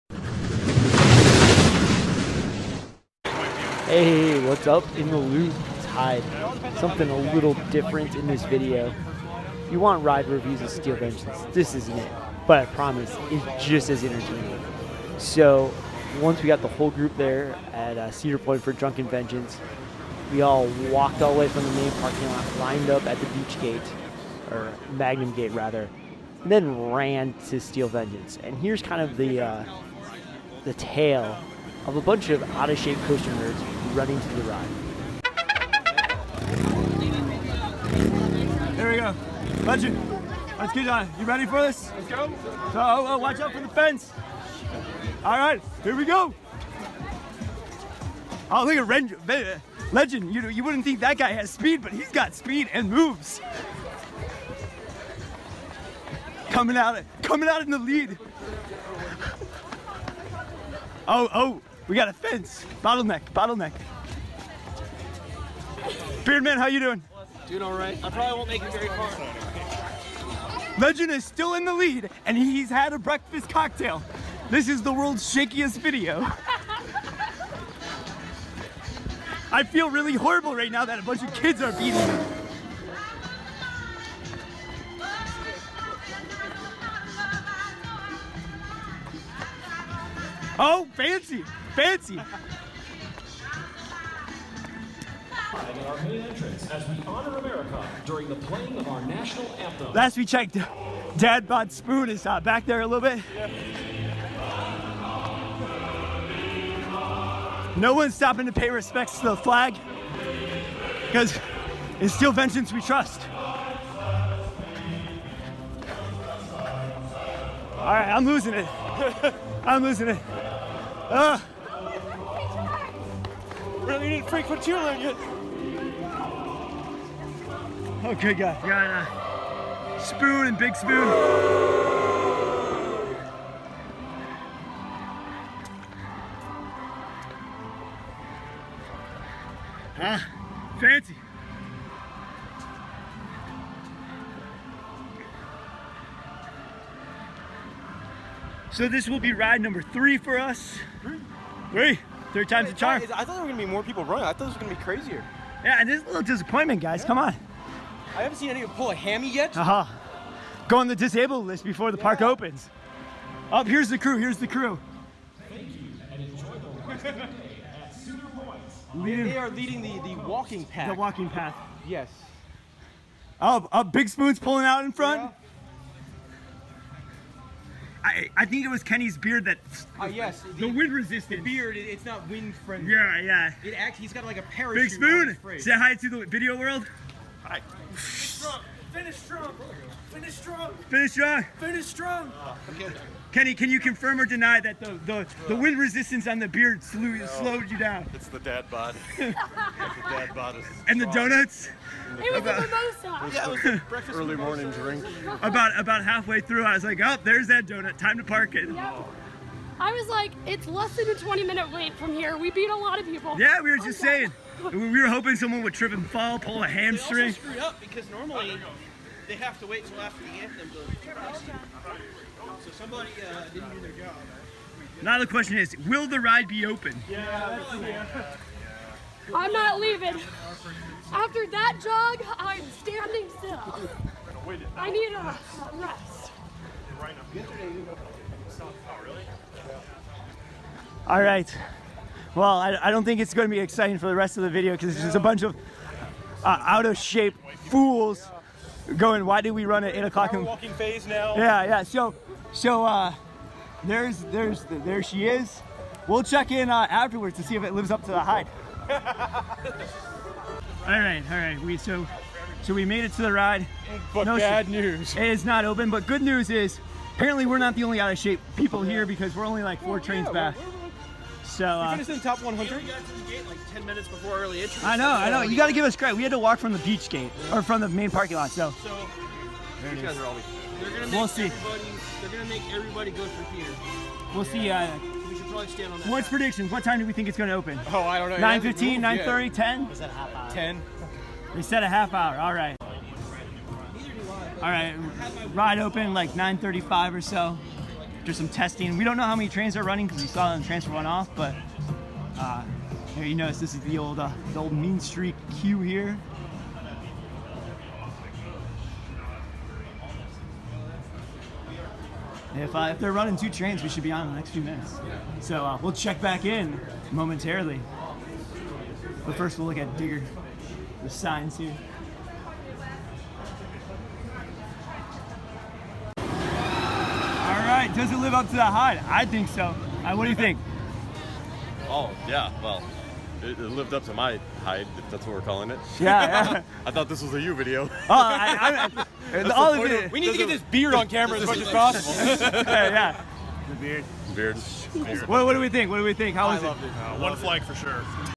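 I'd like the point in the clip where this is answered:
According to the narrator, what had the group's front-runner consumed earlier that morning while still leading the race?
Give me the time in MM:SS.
01:12.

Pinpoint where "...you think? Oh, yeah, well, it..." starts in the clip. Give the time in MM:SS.
05:30.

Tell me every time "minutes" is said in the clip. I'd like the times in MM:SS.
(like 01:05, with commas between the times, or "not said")
03:31, 04:33, 05:14.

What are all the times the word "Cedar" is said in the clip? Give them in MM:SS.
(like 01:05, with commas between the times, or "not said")
00:18, 02:47.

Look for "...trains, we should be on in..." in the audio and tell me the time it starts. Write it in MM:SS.
05:13.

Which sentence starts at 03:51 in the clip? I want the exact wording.
After that jog, I'm standing still.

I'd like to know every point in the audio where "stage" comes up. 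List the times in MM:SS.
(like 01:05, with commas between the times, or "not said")
not said.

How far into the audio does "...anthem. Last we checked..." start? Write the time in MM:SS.
01:39.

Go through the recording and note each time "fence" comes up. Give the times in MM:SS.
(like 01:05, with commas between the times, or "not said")
00:43, 01:02.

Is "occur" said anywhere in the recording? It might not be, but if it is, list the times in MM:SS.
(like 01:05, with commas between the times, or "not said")
not said.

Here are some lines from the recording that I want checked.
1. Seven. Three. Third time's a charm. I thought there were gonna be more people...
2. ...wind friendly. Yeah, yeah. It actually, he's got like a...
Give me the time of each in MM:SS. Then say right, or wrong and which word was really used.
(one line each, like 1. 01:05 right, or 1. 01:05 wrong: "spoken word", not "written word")
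1. 02:31 wrong: "Three", not "Seven"
2. 03:02 right.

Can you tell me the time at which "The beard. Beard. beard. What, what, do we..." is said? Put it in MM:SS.
05:43.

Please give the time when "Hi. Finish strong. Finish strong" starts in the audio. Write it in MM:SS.
03:07.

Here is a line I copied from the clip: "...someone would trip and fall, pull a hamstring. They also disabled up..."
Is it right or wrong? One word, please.
wrong.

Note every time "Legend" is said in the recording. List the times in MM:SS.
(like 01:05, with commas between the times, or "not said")
00:39, 00:49, 01:10.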